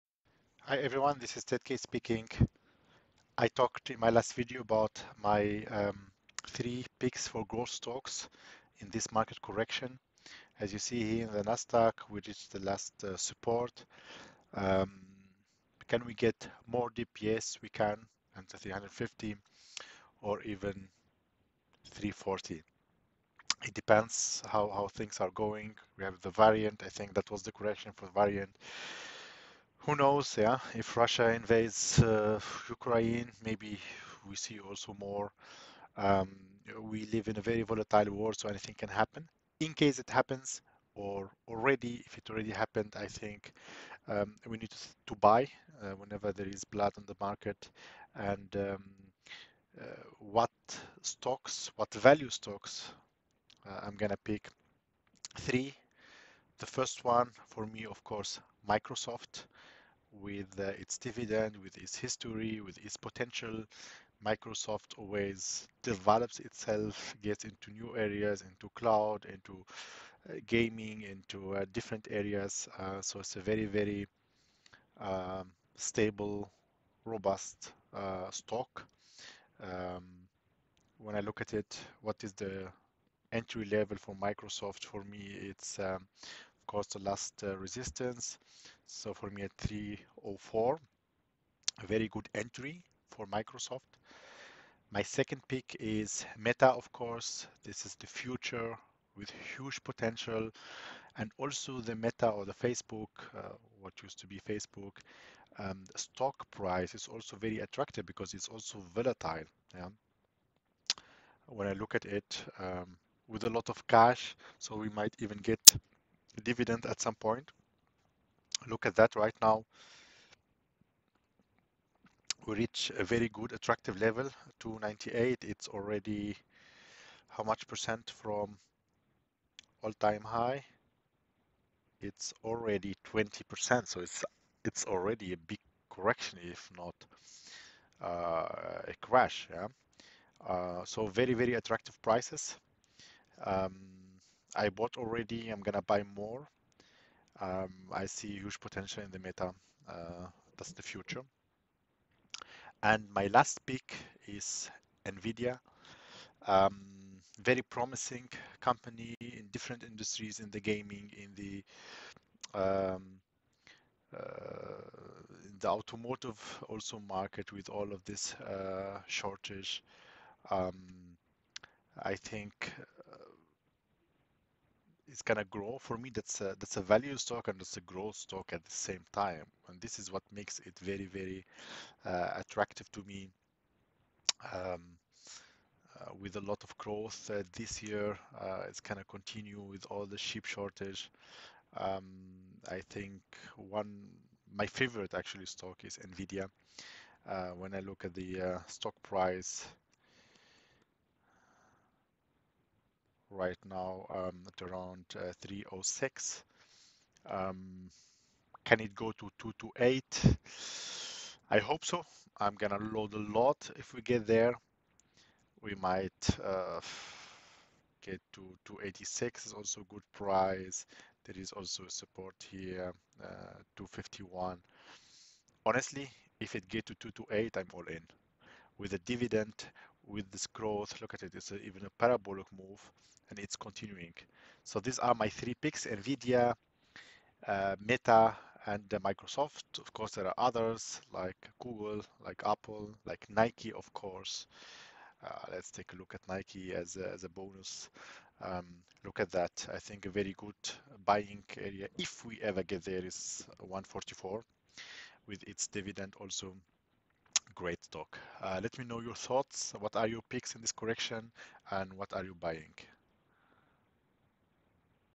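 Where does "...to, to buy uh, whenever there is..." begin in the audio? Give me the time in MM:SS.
00:44.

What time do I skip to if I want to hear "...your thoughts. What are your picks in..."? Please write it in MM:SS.
04:18.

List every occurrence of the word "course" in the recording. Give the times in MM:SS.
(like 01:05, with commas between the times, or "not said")
00:58, 01:26, 01:36, 03:59, 04:03.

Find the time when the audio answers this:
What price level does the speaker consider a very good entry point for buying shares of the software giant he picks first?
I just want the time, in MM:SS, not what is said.
01:29.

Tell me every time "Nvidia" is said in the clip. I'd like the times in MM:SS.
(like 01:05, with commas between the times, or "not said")
02:35, 03:15, 03:55.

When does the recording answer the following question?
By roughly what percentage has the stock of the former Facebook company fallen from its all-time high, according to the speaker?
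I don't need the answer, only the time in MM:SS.
02:13.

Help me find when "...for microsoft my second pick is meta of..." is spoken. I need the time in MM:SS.
01:33.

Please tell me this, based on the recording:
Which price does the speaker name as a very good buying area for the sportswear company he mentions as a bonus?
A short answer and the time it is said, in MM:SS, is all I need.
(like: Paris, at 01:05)
144, at 04:13.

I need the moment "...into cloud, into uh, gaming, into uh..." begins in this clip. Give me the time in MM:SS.
01:08.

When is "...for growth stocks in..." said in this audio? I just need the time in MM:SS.
00:07.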